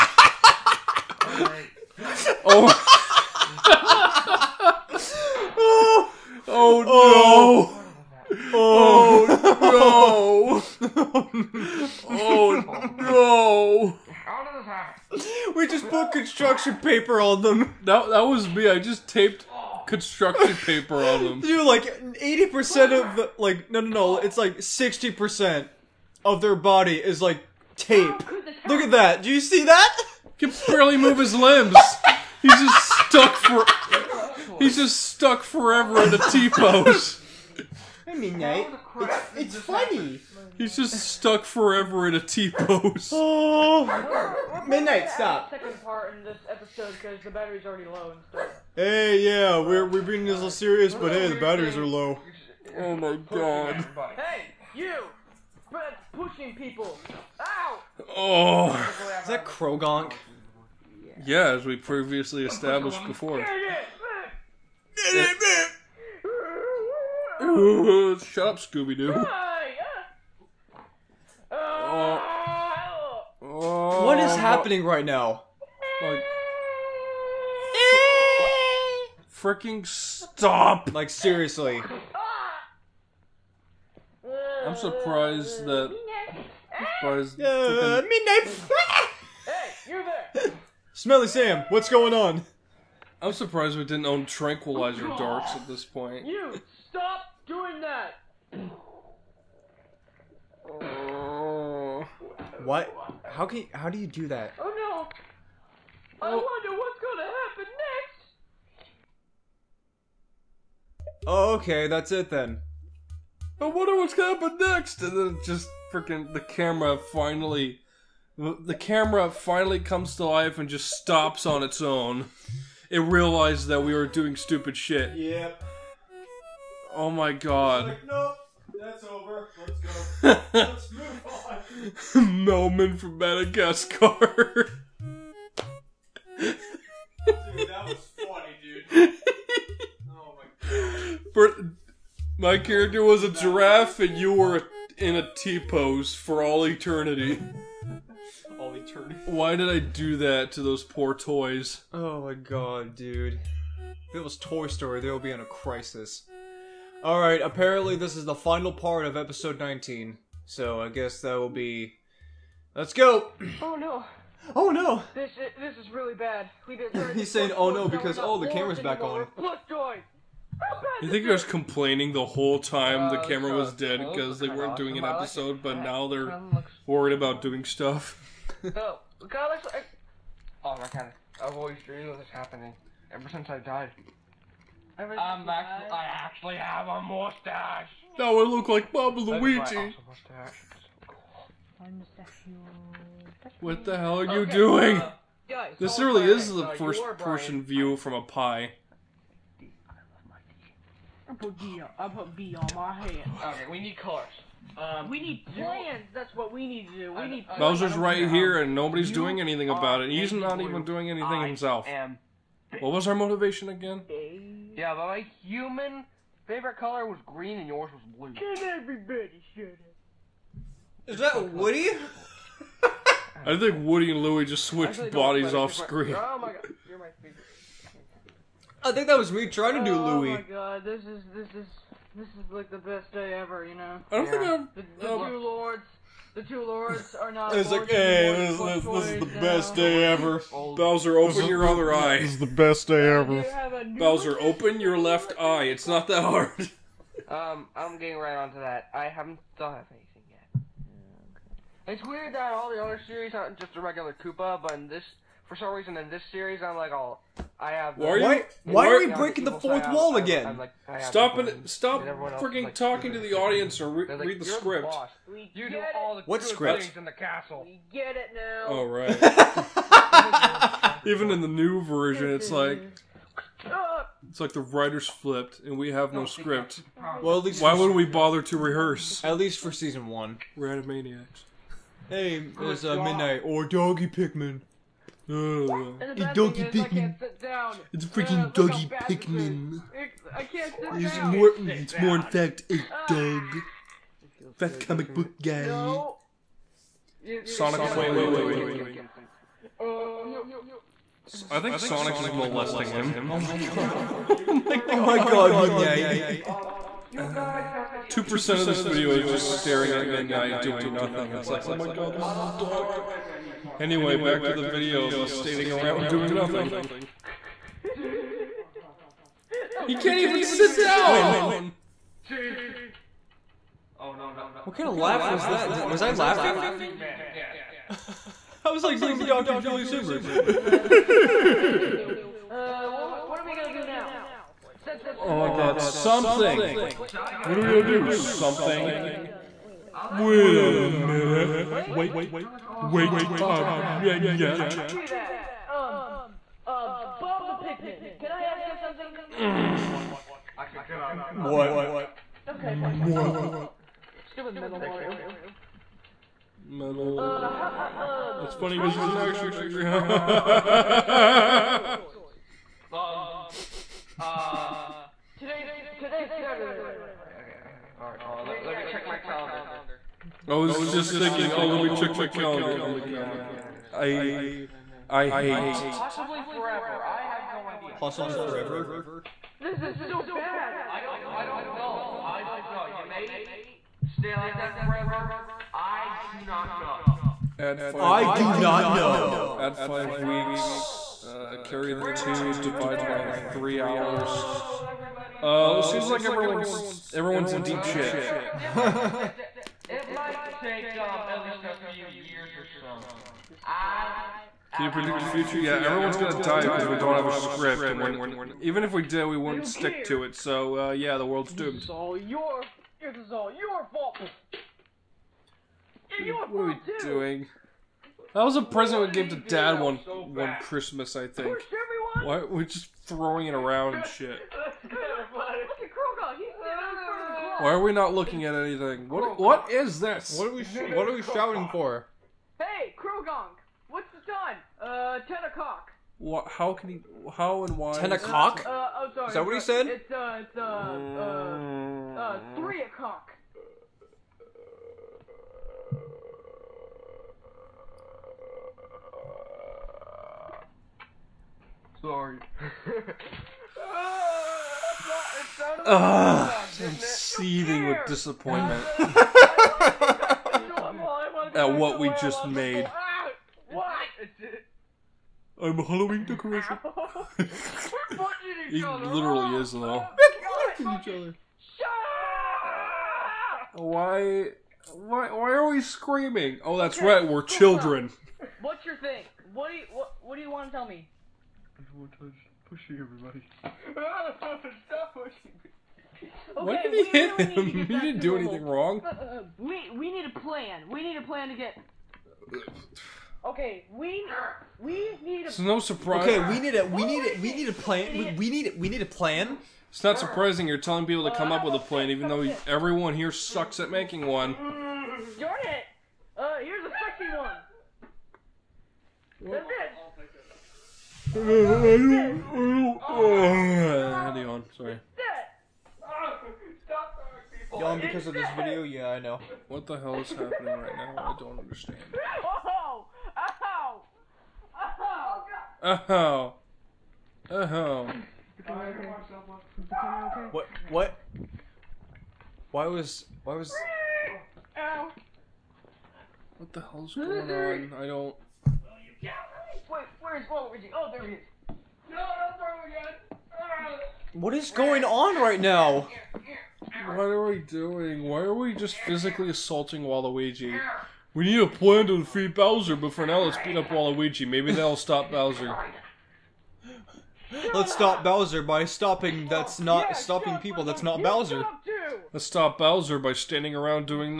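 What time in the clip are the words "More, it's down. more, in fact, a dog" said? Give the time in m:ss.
4:51.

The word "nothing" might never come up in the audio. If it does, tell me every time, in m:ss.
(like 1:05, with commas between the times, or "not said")
5:10, 5:16.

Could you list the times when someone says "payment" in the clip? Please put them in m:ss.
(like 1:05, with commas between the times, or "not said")
not said.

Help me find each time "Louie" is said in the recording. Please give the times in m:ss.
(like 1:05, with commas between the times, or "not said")
3:44, 3:50.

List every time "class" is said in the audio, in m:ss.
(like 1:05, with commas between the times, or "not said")
not said.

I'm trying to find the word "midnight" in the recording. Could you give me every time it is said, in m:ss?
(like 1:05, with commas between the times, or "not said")
0:44, 1:28, 4:43, 5:10.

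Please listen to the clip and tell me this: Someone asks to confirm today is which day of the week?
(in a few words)
Saturday.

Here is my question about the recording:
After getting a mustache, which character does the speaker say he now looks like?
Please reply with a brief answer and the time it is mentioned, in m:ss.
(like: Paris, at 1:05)
Bob Luigi, at 3:08.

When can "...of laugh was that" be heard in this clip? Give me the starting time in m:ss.
5:24.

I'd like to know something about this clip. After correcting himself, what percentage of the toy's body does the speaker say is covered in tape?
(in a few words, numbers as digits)
60%.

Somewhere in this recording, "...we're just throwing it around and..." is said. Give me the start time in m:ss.
7:02.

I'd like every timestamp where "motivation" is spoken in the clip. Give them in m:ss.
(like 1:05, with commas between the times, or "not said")
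3:33.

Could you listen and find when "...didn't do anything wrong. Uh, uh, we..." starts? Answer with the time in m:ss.
8:07.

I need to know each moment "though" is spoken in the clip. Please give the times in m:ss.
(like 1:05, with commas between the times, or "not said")
7:49, 8:22.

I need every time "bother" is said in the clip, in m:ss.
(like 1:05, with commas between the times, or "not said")
4:38.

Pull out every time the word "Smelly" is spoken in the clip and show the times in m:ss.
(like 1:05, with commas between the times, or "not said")
1:30.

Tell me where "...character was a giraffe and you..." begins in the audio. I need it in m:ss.
2:22.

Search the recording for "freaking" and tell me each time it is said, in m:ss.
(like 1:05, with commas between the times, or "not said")
1:19, 1:55, 4:22, 4:48.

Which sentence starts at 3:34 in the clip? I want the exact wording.
Yeah, but my human favorite color was green and yours was blue.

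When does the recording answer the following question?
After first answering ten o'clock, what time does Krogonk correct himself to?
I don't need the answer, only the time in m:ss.
7:22.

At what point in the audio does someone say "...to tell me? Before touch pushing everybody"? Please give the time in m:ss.
8:00.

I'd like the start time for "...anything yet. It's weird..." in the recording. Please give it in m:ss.
4:09.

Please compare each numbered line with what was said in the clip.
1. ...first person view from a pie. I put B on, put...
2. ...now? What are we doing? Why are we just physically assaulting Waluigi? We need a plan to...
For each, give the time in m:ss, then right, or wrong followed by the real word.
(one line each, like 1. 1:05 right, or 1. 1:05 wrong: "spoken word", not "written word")
1. 3:16 right
2. 9:05 right.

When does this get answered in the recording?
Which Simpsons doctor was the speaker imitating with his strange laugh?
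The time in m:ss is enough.
5:29.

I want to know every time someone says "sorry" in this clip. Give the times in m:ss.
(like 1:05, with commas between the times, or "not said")
7:19, 7:32, 8:34.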